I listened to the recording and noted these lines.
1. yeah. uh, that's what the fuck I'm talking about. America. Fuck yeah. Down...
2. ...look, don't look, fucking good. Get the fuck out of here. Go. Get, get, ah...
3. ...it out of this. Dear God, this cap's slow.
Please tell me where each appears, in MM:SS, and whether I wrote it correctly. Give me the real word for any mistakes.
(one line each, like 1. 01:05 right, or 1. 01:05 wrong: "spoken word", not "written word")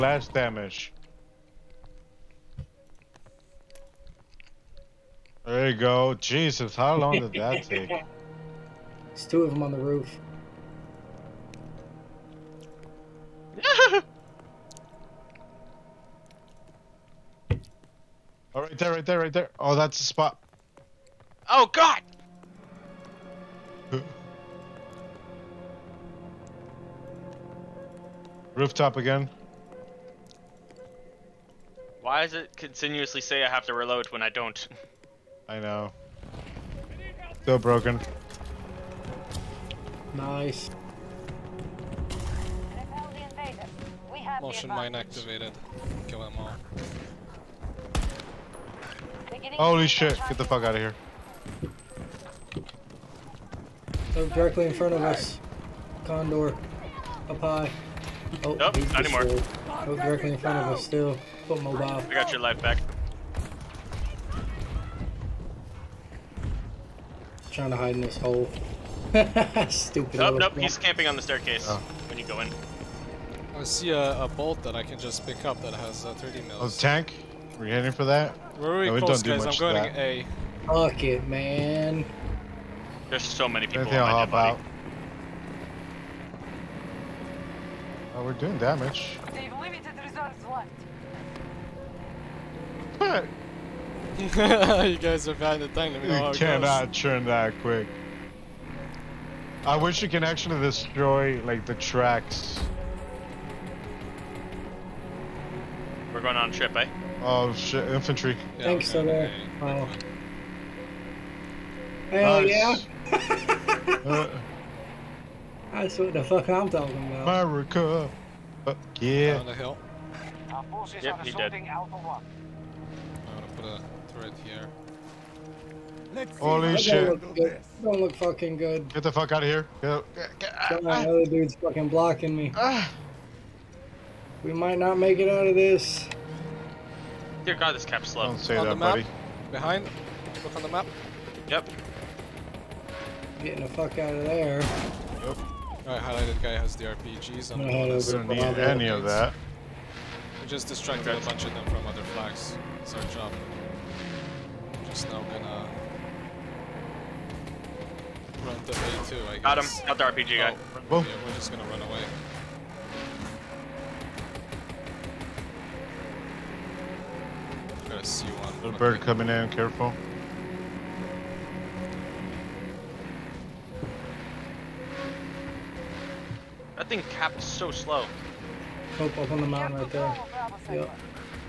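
1. 01:53 right
2. 02:07 right
3. 02:15 right.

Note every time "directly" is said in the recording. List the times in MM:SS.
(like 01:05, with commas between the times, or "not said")
00:54, 00:59.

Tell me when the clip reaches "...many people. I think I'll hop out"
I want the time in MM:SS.
01:23.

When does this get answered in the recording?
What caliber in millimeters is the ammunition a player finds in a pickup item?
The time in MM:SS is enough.
01:16.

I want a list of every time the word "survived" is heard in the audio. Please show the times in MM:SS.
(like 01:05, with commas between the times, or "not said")
not said.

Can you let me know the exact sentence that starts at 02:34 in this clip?
just now gonna run the A2, I guess.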